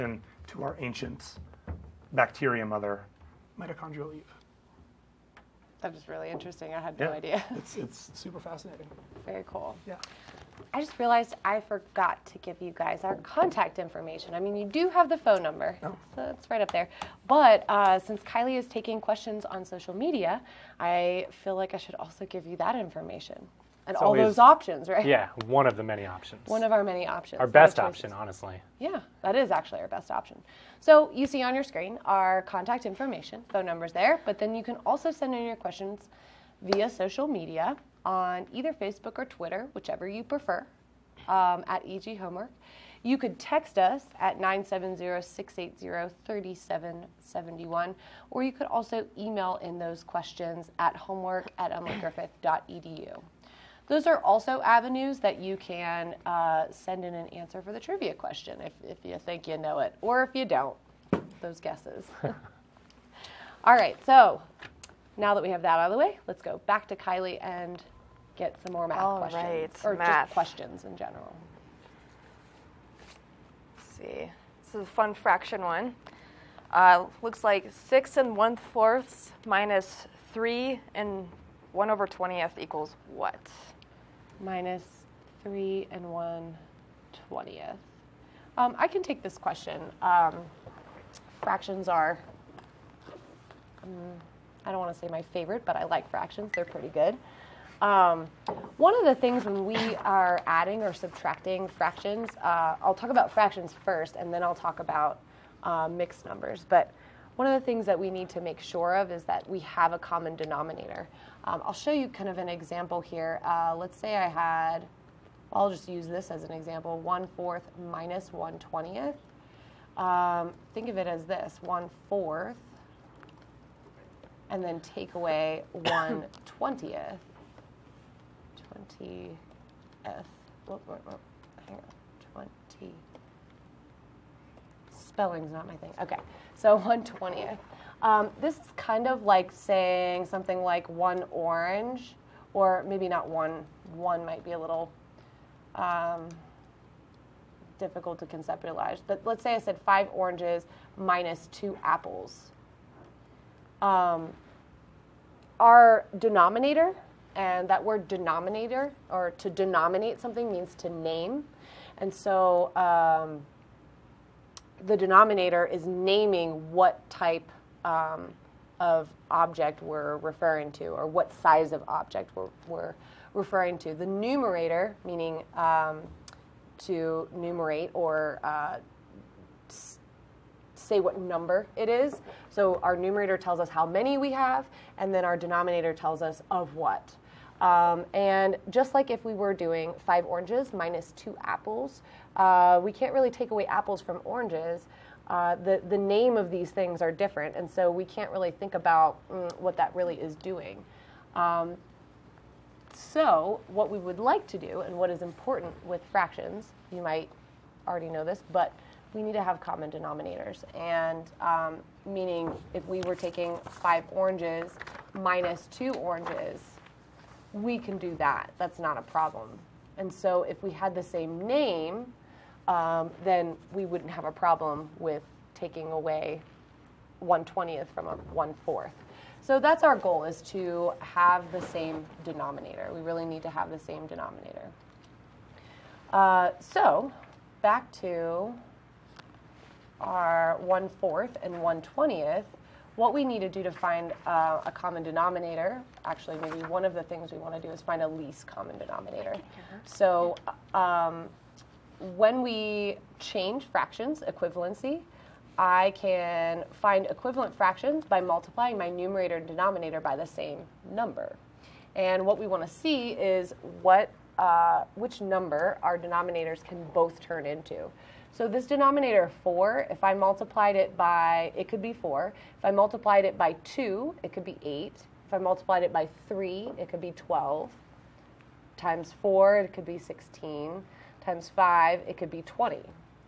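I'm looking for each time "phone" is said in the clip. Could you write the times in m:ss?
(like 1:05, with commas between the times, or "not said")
0:15, 0:33.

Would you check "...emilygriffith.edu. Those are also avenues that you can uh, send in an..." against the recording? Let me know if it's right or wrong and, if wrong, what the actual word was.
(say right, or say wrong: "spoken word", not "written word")
right.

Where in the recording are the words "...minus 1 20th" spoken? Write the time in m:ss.
1:57.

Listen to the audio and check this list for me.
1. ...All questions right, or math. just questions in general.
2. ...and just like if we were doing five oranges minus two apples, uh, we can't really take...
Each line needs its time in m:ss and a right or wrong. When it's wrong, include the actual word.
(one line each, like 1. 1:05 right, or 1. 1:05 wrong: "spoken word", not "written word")
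1. 1:09 right
2. 3:08 right.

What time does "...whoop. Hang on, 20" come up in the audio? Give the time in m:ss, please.
2:11.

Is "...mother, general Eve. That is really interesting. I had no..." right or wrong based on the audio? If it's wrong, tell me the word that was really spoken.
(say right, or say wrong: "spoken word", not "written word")
wrong: "mitochondrial", not "general".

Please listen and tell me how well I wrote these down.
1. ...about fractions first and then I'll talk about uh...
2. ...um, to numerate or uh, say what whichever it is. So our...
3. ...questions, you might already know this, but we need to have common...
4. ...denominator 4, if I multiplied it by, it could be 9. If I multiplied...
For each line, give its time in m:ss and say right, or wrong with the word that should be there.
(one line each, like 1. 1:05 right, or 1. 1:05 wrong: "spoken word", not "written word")
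1. 1:43 right
2. 2:55 wrong: "number", not "whichever"
3. 3:26 wrong: "fractions", not "questions"
4. 4:28 wrong: "4", not "9".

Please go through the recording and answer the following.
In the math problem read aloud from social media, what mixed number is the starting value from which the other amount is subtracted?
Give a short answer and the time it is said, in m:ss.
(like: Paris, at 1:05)
6 1/4, at 1:17.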